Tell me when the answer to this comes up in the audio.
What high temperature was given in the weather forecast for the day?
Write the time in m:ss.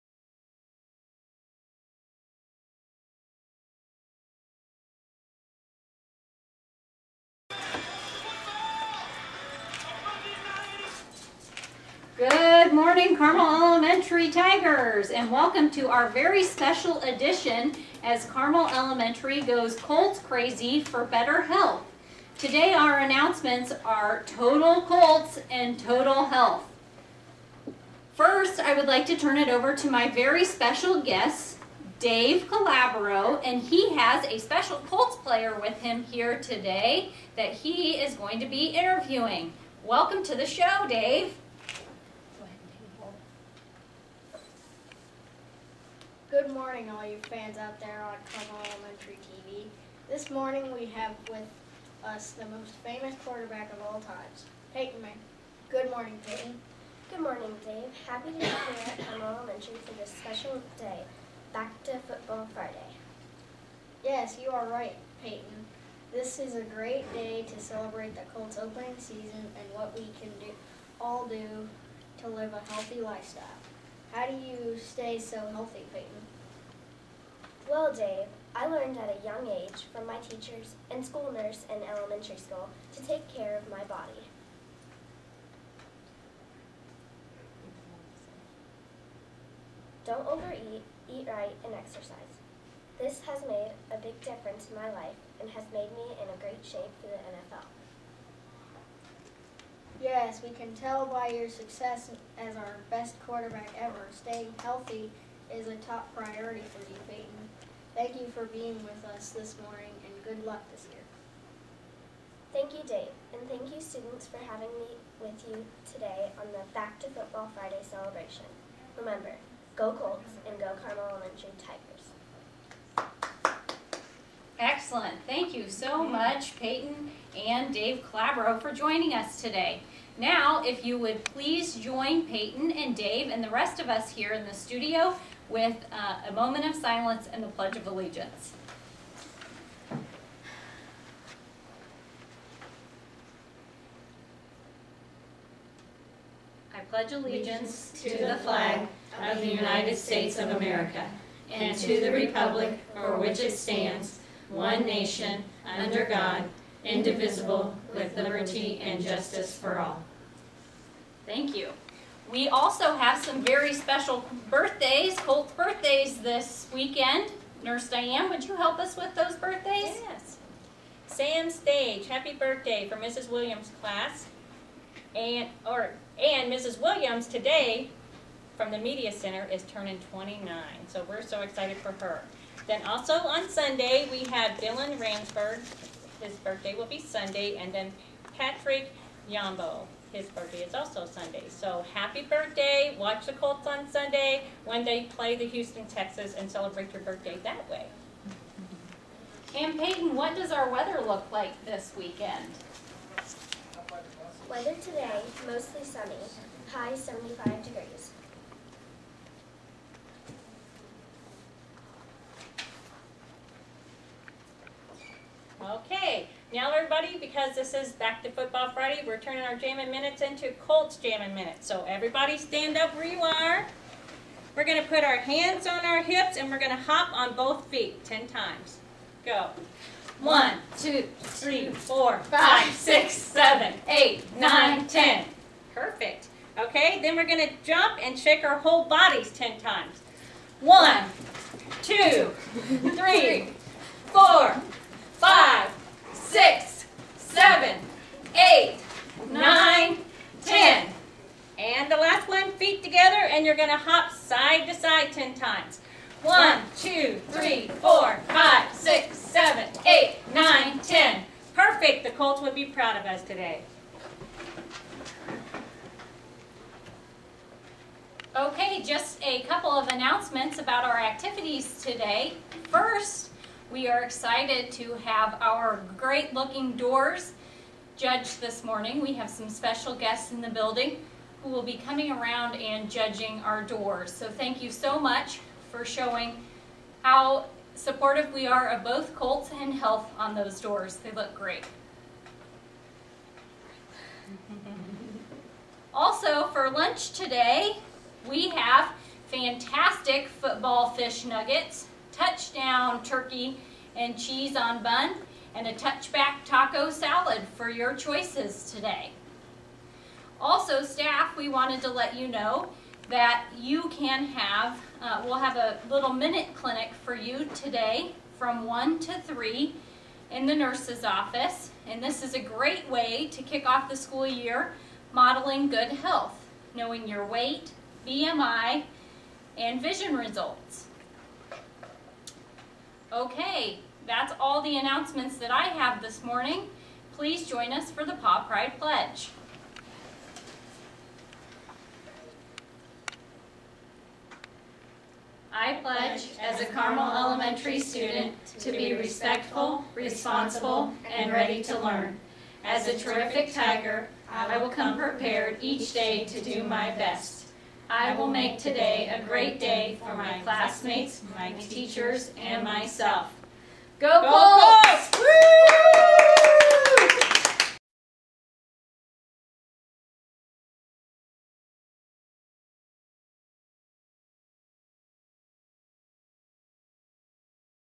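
3:26.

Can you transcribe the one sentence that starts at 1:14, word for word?
How do you stay so healthy, Peyton?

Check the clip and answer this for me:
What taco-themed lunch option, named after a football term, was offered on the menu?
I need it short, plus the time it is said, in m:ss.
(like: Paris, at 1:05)
touchback taco salad, at 5:05.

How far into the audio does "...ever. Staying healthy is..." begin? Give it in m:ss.
1:43.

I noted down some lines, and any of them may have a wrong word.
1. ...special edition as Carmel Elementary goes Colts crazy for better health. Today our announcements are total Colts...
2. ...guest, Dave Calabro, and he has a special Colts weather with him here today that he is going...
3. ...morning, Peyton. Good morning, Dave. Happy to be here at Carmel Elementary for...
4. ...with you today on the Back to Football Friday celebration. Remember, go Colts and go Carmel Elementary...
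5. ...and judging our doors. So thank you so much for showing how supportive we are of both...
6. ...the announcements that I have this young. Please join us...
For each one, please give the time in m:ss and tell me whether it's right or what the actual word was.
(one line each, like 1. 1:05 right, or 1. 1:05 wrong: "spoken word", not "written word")
1. 0:16 right
2. 0:31 wrong: "player", not "weather"
3. 0:55 right
4. 1:55 right
5. 4:42 right
6. 5:34 wrong: "morning", not "young".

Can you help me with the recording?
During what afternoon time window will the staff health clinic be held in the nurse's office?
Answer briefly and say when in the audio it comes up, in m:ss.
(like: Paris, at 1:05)
1 to 3, at 5:18.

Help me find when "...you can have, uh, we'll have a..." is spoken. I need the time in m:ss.
5:13.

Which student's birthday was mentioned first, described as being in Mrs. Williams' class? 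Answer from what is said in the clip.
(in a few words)
Sam Stage.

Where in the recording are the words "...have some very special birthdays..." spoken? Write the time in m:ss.
2:42.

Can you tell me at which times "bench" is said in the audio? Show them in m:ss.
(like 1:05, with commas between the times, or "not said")
not said.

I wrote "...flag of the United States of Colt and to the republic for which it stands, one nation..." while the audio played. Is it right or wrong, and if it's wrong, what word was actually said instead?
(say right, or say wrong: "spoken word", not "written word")
wrong: "America", not "Colt".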